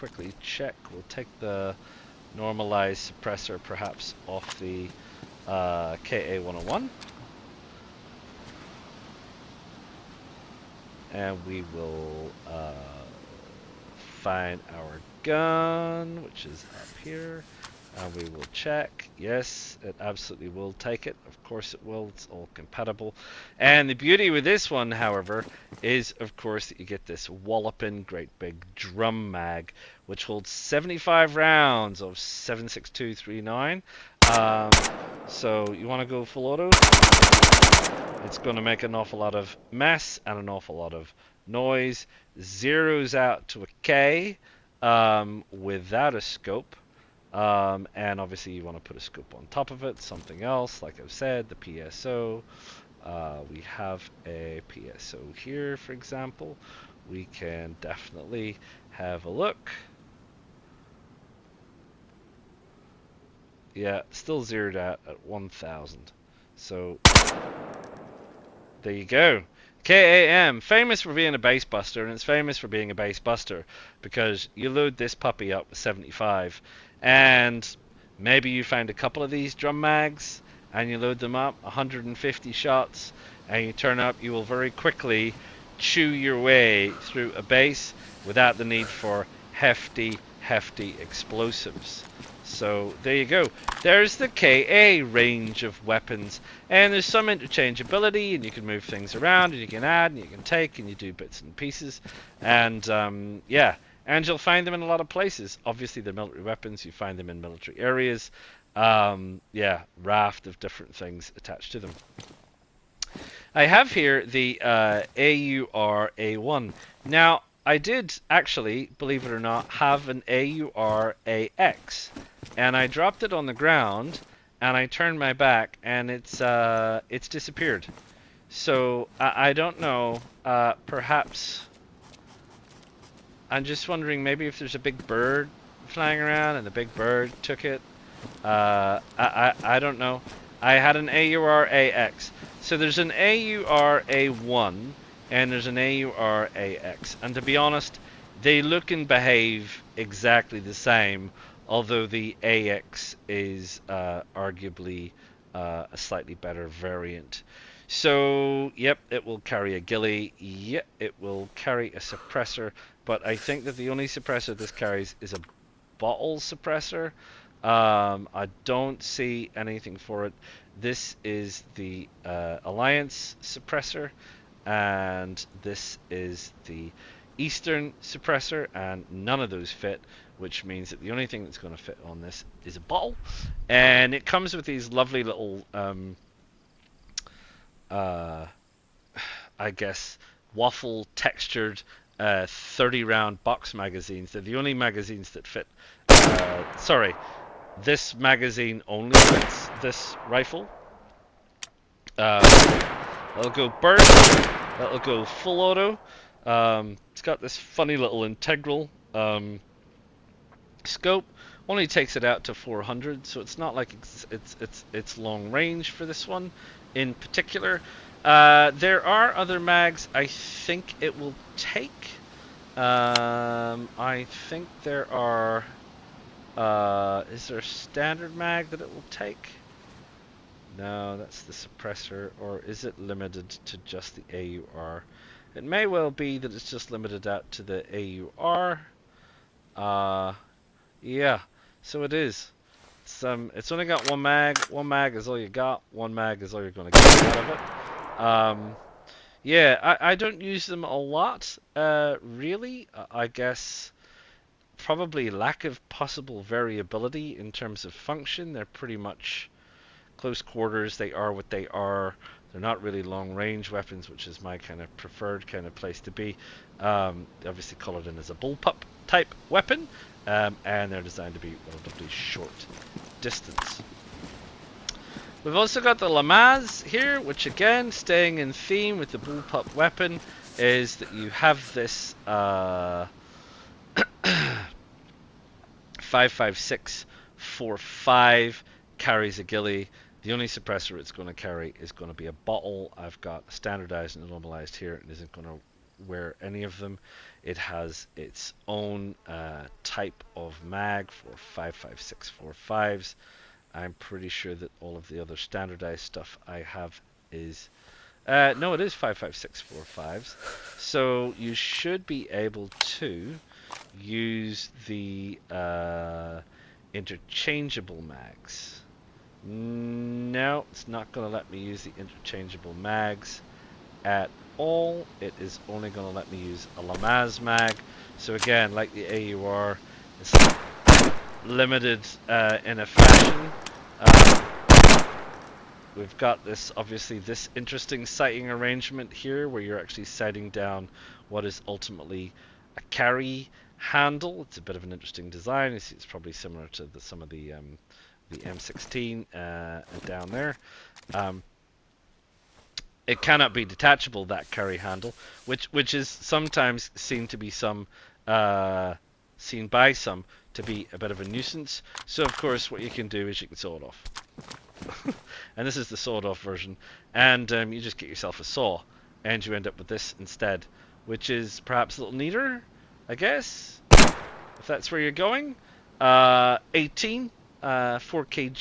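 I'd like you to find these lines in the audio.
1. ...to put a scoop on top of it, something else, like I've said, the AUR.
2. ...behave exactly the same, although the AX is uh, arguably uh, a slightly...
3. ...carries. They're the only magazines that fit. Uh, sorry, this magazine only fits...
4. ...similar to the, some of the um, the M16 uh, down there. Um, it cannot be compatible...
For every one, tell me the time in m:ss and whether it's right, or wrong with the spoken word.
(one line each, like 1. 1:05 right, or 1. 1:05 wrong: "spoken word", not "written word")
1. 0:48 wrong: "PSO", not "AUR"
2. 2:29 right
3. 3:13 wrong: "magazines", not "carries"
4. 5:46 wrong: "detachable", not "compatible".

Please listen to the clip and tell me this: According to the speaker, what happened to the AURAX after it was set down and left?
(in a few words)
It disappeared.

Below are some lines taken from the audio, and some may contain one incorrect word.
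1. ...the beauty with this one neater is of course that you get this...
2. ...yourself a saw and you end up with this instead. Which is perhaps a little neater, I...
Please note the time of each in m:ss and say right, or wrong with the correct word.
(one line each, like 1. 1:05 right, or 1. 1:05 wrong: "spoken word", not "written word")
1. 0:23 wrong: "however", not "neater"
2. 6:08 right.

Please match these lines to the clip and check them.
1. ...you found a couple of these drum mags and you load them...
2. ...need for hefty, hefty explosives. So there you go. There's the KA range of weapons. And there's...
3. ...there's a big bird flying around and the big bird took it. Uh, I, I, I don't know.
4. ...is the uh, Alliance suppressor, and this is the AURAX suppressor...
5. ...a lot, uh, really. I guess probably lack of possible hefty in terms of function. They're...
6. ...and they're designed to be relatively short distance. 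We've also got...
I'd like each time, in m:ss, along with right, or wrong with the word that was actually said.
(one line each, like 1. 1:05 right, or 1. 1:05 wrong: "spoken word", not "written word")
1. 1:18 right
2. 1:28 right
3. 2:14 right
4. 2:51 wrong: "Eastern", not "AURAX"
5. 4:10 wrong: "variability", not "hefty"
6. 4:30 right.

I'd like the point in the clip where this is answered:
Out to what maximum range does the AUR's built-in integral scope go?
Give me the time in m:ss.
3:32.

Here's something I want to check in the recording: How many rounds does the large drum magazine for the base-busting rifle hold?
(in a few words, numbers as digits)
75.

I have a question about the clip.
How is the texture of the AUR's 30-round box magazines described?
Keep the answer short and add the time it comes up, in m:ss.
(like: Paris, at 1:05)
waffle textured, at 3:10.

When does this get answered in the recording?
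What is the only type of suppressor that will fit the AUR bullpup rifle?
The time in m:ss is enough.
2:45.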